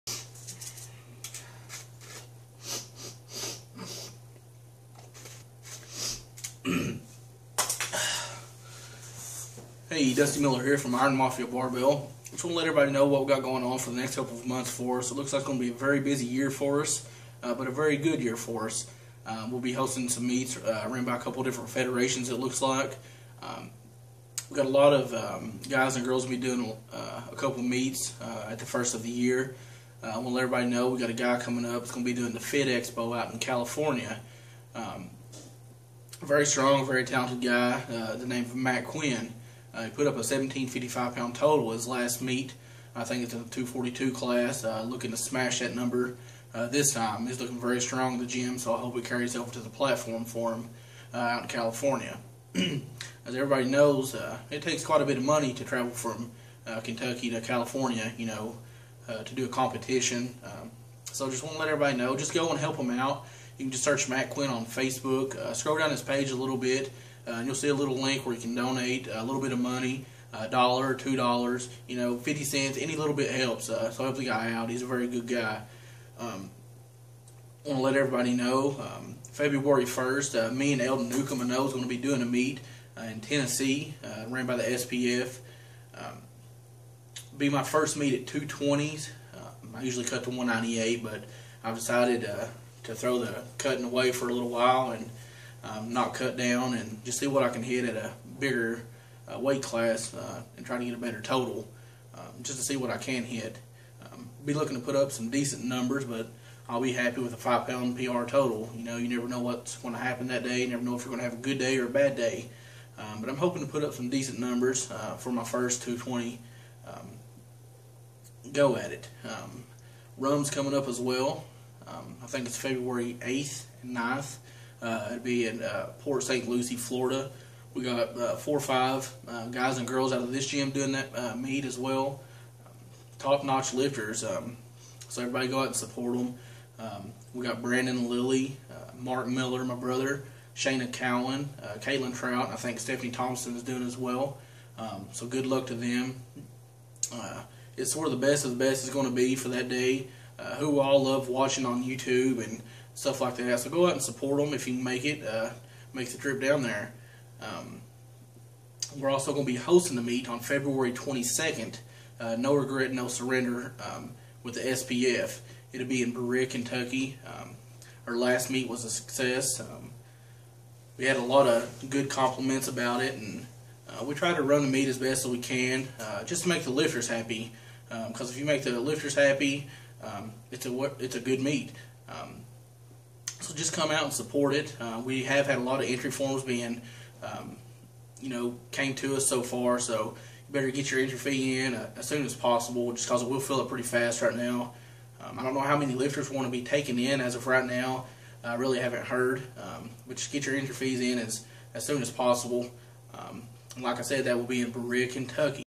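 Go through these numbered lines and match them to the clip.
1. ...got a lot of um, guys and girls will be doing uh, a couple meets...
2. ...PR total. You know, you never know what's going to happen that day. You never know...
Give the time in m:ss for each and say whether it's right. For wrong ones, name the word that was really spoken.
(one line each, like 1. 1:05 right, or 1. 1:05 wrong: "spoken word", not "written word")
1. 0:24 right
2. 1:47 right.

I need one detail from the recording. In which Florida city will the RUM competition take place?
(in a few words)
Port St. Lucie.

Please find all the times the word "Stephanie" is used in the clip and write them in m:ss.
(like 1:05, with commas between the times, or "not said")
2:22.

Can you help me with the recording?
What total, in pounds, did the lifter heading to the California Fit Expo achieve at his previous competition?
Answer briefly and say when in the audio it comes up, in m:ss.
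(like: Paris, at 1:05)
1755, at 0:40.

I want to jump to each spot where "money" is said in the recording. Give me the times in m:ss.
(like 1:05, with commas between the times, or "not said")
0:55, 1:09.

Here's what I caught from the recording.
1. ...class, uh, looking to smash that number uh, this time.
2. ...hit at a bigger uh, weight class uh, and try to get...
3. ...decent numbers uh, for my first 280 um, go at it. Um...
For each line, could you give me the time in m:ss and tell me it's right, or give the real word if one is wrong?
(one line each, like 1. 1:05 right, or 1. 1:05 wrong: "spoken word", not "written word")
1. 0:44 right
2. 1:37 right
3. 1:54 wrong: "220", not "280".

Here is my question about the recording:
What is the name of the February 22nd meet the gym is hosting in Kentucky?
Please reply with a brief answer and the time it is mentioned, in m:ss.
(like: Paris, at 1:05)
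No Regret, No Surrender, at 2:42.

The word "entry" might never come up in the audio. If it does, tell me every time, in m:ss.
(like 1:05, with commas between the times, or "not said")
3:05, 3:10, 3:20.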